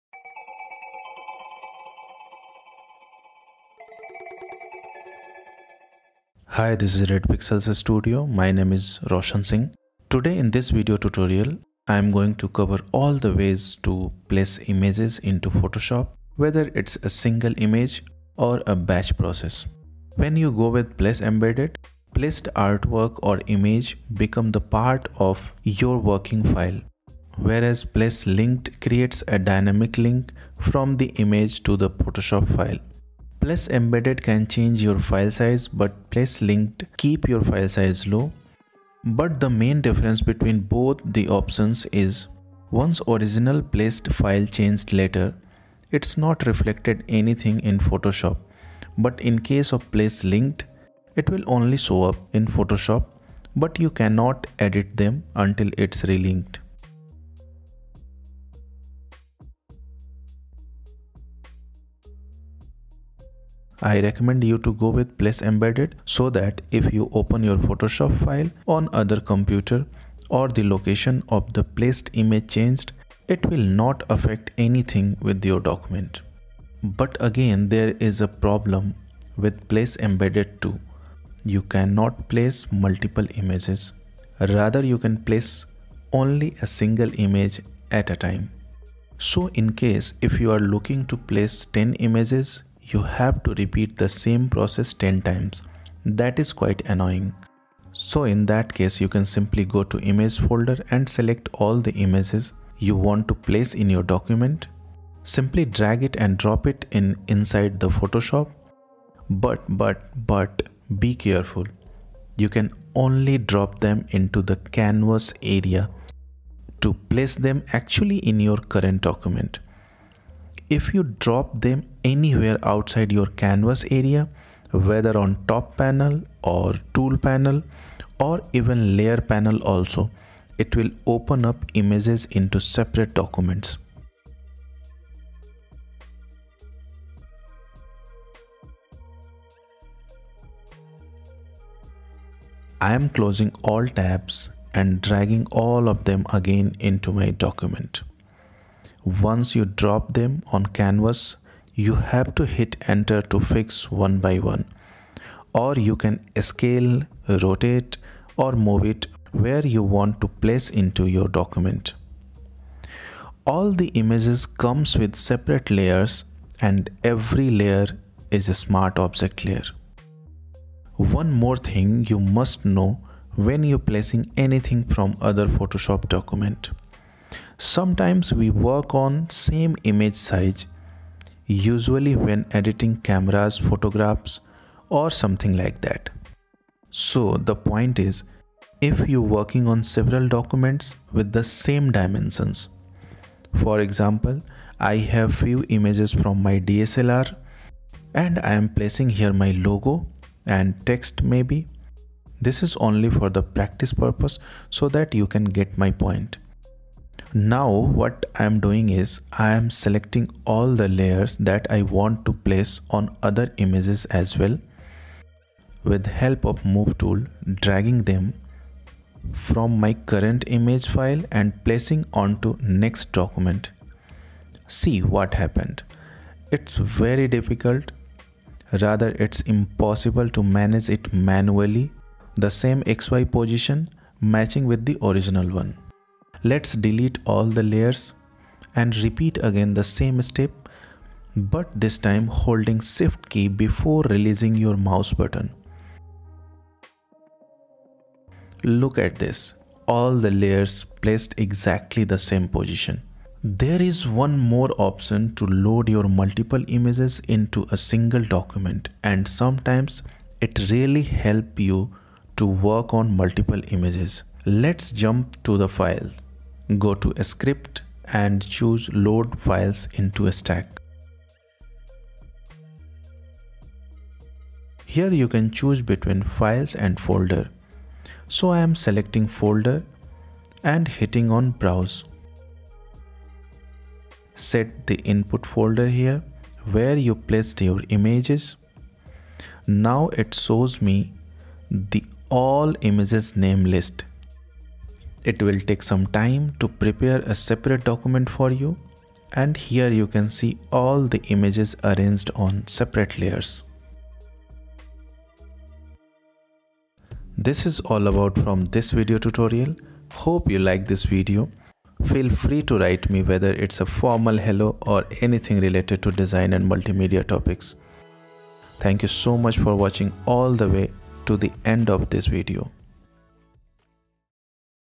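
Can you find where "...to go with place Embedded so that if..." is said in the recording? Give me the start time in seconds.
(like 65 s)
64 s.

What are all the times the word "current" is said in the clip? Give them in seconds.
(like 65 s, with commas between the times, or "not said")
118 s, 219 s.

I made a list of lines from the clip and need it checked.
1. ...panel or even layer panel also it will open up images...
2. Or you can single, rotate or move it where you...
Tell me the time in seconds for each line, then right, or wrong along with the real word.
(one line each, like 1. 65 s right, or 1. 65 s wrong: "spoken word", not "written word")
1. 127 s right
2. 155 s wrong: "scale", not "single".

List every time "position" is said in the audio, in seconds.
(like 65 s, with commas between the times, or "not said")
233 s, 252 s.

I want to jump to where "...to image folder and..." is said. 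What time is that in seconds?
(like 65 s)
99 s.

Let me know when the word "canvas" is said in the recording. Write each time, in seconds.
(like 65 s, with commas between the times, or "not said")
114 s, 123 s, 150 s.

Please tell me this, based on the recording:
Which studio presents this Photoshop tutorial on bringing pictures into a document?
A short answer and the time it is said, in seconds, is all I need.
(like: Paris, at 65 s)
Red Pixels Studio, at 7 s.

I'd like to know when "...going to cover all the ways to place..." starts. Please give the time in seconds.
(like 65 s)
12 s.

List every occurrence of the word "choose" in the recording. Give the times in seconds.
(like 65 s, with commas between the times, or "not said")
268 s, 275 s.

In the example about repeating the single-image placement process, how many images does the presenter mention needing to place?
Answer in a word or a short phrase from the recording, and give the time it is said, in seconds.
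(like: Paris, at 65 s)
10, at 91 s.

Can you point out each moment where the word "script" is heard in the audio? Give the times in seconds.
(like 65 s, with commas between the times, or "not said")
267 s.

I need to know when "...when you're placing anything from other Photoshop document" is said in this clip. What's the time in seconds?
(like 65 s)
173 s.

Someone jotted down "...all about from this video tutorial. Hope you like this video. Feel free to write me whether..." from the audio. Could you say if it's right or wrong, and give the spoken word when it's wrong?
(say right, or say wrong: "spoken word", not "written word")
right.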